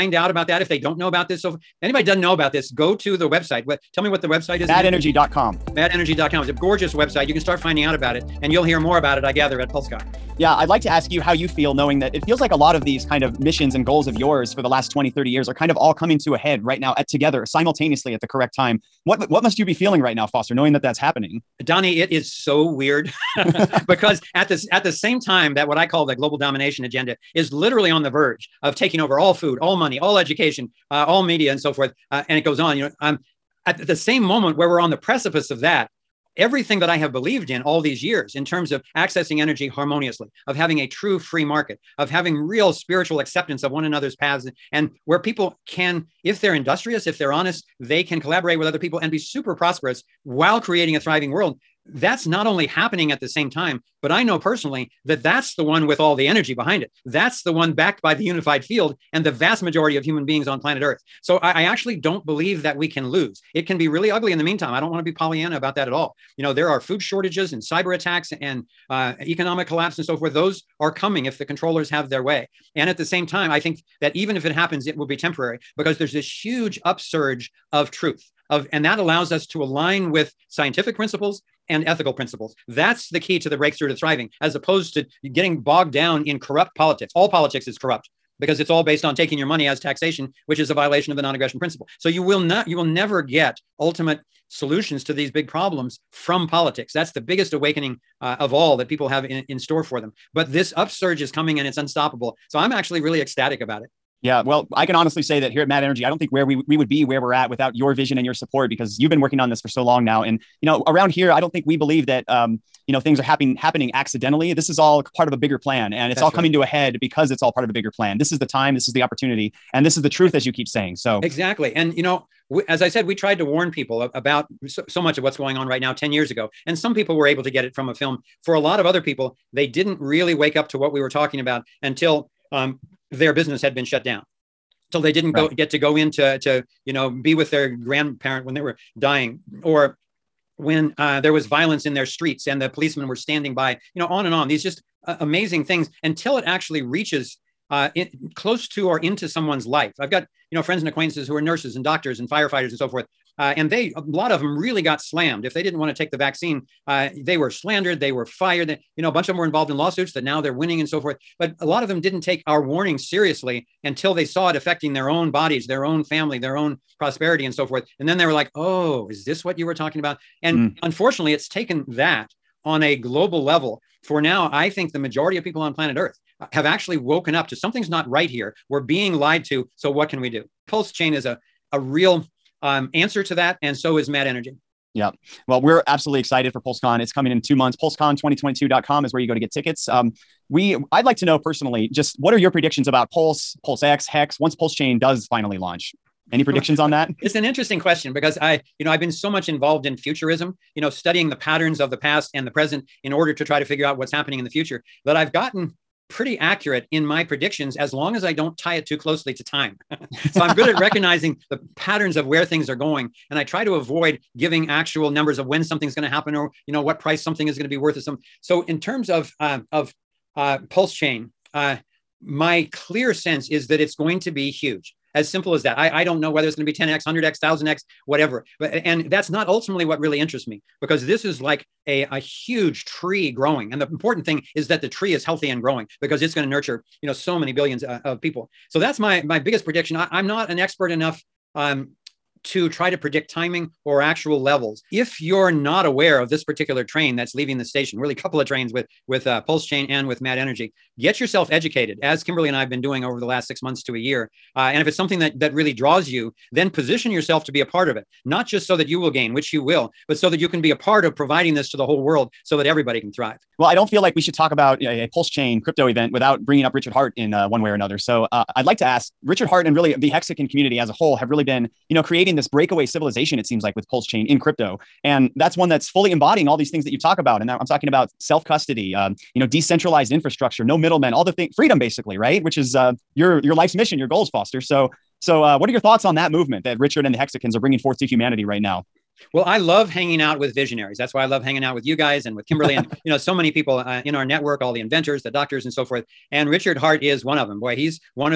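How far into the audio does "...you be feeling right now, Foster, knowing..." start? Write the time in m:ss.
0:19.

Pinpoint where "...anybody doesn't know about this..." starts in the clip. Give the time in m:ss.
0:01.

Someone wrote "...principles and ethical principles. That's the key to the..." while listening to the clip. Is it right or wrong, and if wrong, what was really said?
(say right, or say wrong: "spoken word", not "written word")
right.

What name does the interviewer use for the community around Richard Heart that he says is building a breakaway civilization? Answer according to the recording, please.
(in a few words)
Hexicans.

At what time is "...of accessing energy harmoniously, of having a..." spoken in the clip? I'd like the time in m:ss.
0:38.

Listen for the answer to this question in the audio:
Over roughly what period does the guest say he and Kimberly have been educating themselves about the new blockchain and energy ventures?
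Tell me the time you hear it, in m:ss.
4:13.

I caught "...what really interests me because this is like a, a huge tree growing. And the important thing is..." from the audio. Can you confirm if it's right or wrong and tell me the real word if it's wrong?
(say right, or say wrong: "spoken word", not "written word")
right.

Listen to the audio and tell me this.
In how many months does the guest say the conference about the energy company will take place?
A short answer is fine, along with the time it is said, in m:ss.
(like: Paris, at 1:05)
2, at 3:07.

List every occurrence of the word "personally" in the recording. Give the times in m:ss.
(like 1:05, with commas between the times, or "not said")
0:54, 3:11.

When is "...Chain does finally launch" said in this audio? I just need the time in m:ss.
3:14.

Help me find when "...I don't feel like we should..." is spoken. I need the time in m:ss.
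4:23.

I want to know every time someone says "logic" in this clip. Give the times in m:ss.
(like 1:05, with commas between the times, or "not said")
not said.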